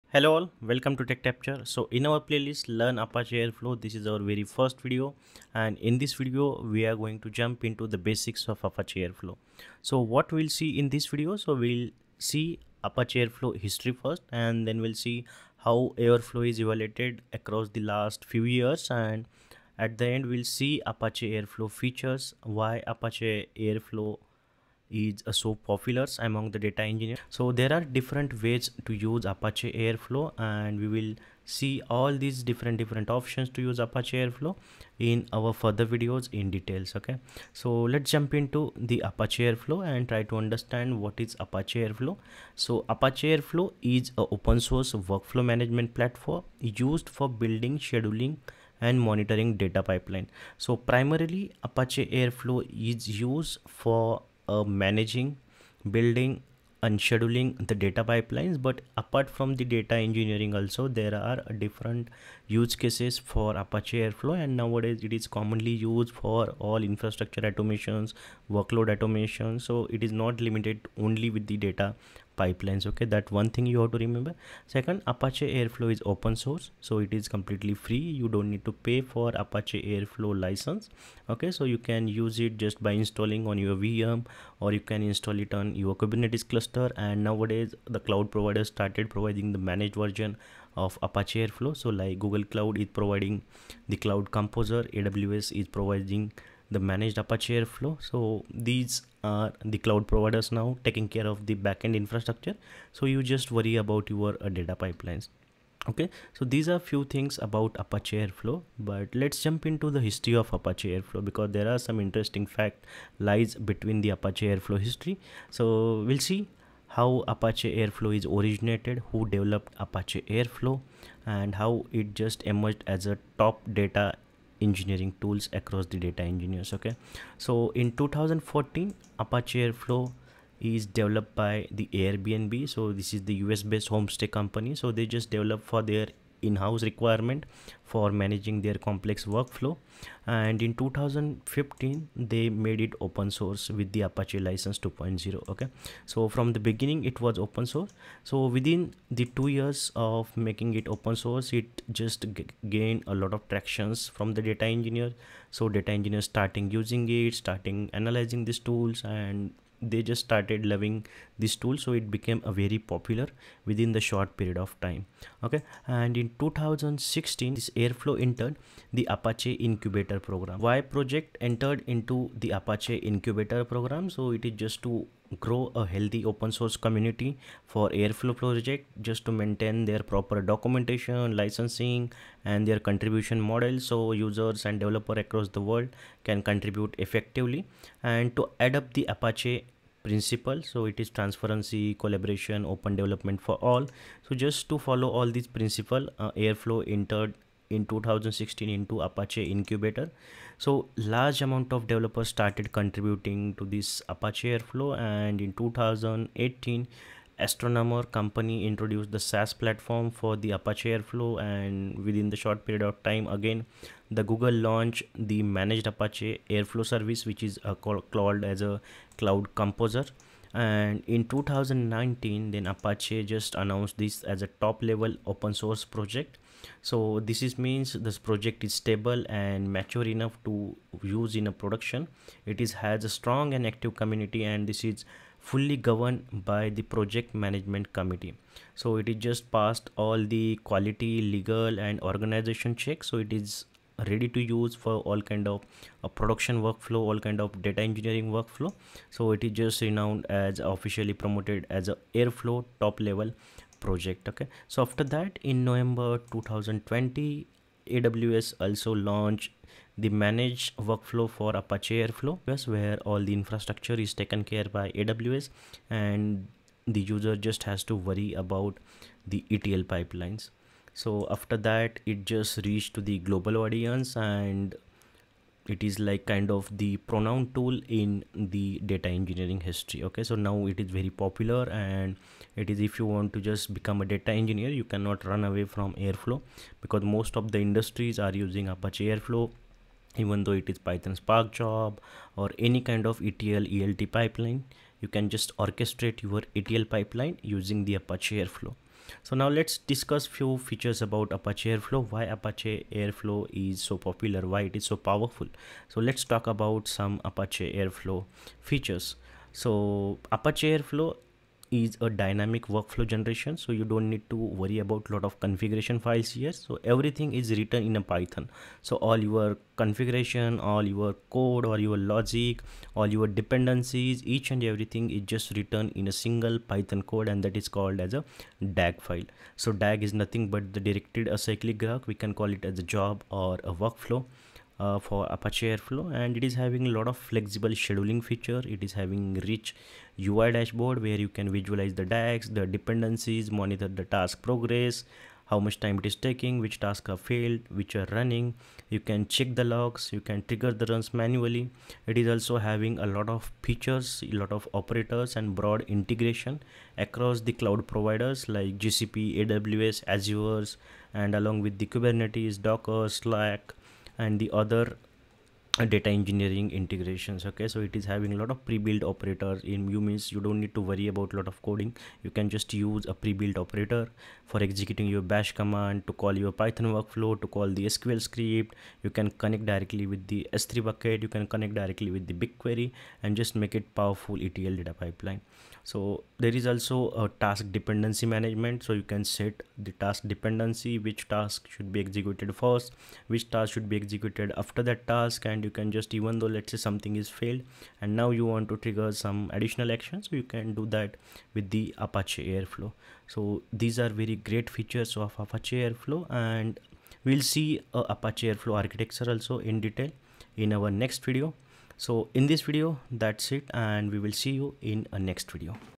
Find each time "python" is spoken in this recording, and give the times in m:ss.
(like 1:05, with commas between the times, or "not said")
4:50, 5:18, 5:26, 6:16.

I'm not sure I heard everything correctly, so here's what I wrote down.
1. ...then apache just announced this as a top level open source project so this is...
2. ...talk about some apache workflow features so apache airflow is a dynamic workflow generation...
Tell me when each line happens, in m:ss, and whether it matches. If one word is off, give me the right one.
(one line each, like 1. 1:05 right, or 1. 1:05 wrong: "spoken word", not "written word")
1. 3:42 right
2. 5:06 wrong: "airflow", not "workflow".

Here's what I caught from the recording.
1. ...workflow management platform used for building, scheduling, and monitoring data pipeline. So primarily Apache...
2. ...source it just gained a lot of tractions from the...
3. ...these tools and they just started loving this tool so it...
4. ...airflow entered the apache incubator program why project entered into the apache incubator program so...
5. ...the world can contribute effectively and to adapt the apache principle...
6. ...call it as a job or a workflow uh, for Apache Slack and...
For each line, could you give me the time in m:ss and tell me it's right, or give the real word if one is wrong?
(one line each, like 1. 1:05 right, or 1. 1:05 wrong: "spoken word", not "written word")
1. 0:44 right
2. 2:31 right
3. 2:38 right
4. 2:47 right
5. 3:05 right
6. 5:32 wrong: "Airflow", not "Slack".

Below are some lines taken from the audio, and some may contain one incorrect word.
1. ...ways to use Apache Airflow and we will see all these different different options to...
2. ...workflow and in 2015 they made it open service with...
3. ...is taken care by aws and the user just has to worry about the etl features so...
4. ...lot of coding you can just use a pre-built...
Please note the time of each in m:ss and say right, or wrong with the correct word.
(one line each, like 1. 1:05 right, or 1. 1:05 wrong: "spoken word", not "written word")
1. 0:28 right
2. 2:19 wrong: "source", not "service"
3. 4:23 wrong: "pipelines", not "features"
4. 6:11 right.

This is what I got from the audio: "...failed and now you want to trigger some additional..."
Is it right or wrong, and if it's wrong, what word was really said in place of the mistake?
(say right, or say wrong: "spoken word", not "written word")
right.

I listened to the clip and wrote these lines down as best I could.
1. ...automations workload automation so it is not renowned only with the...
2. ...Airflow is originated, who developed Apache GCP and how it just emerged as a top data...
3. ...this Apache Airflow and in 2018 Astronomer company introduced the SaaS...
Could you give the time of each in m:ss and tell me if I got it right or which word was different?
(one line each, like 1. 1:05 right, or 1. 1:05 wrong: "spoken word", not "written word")
1. 1:07 wrong: "limited", not "renowned"
2. 1:57 wrong: "Airflow", not "GCP"
3. 3:23 right.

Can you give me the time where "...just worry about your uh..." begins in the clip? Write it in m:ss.
1:43.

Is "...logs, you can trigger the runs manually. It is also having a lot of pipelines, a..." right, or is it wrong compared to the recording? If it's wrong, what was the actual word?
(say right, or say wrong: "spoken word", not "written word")
wrong: "features", not "pipelines".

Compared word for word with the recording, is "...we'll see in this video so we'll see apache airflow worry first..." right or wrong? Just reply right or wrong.
wrong.